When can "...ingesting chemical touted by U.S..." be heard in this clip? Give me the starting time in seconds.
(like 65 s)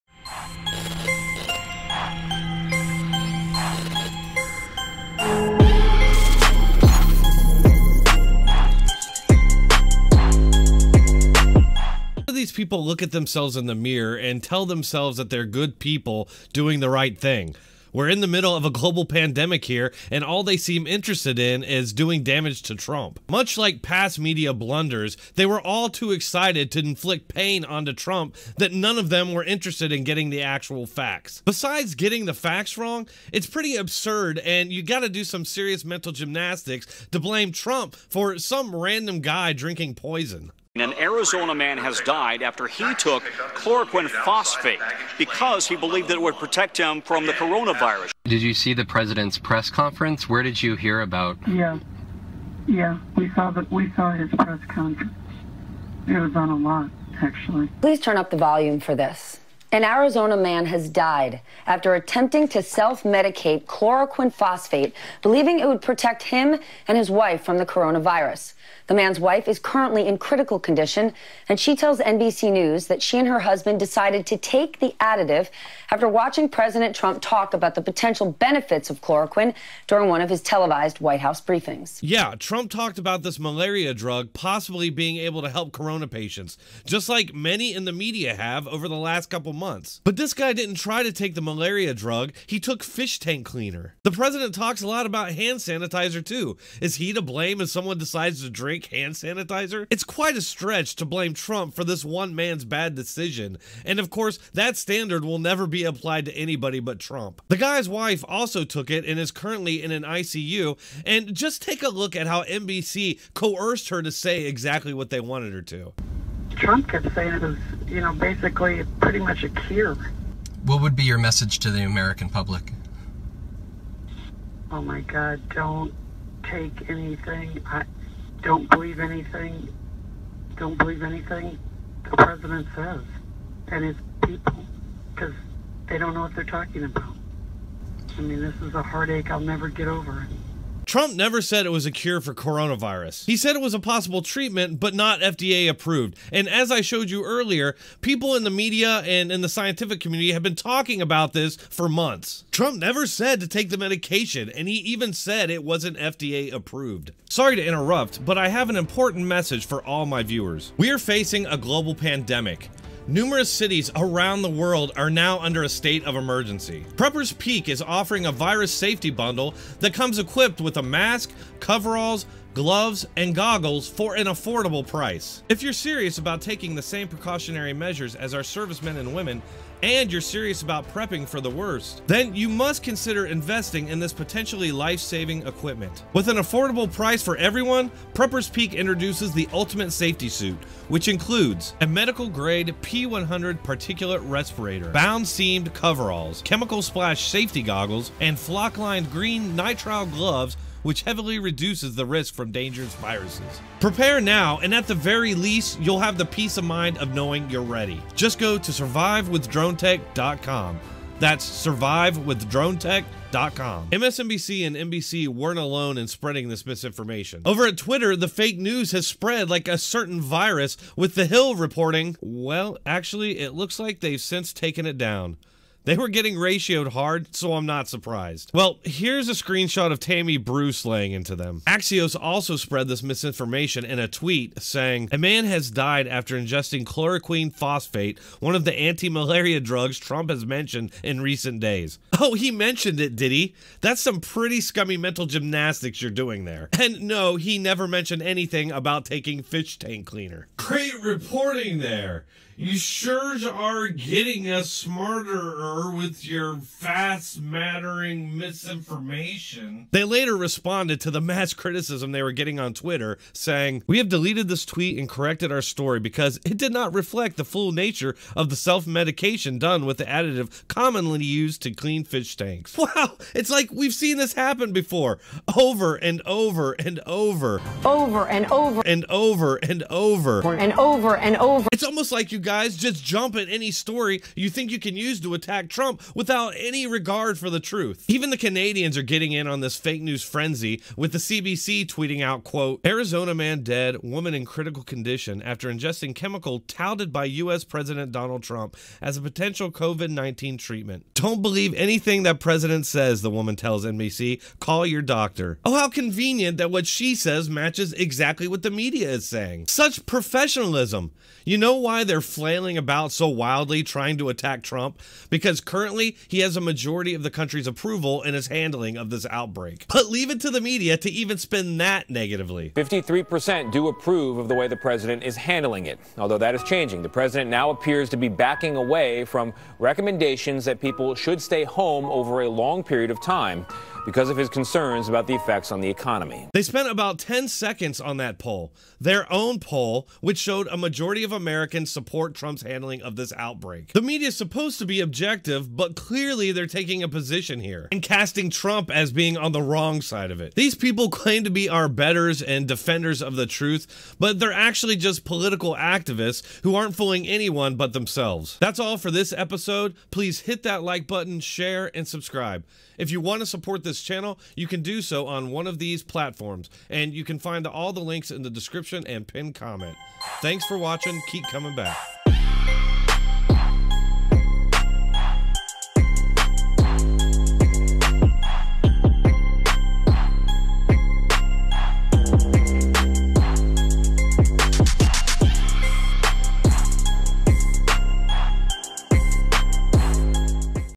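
295 s.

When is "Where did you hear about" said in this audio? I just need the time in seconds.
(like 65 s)
50 s.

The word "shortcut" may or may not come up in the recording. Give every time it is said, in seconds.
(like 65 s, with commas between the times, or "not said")
not said.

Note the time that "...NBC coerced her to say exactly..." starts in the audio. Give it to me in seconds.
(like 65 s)
112 s.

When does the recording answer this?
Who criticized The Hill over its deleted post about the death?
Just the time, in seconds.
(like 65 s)
229 s.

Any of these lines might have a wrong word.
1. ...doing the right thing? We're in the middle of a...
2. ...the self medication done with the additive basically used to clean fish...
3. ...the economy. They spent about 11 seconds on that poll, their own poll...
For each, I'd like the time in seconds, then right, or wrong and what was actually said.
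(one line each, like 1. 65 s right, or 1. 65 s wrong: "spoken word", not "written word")
1. 16 s right
2. 268 s wrong: "commonly", not "basically"
3. 335 s wrong: "10", not "11".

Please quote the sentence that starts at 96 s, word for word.
Is he to blame if someone decides to drink hand sanitizer?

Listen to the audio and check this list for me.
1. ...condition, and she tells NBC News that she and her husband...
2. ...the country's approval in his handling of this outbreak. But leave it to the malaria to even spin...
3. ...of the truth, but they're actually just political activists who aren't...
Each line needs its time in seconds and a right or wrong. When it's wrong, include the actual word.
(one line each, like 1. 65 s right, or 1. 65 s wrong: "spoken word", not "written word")
1. 70 s right
2. 317 s wrong: "media", not "malaria"
3. 353 s right.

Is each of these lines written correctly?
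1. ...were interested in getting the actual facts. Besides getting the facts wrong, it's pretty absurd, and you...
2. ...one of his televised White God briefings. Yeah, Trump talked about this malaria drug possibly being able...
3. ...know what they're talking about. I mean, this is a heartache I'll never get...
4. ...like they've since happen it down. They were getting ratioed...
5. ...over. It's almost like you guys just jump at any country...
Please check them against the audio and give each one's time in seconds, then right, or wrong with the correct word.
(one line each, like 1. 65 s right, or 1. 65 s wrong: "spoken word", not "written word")
1. 29 s right
2. 80 s wrong: "House", not "God"
3. 136 s right
4. 223 s wrong: "taken", not "happen"
5. 281 s wrong: "story", not "country".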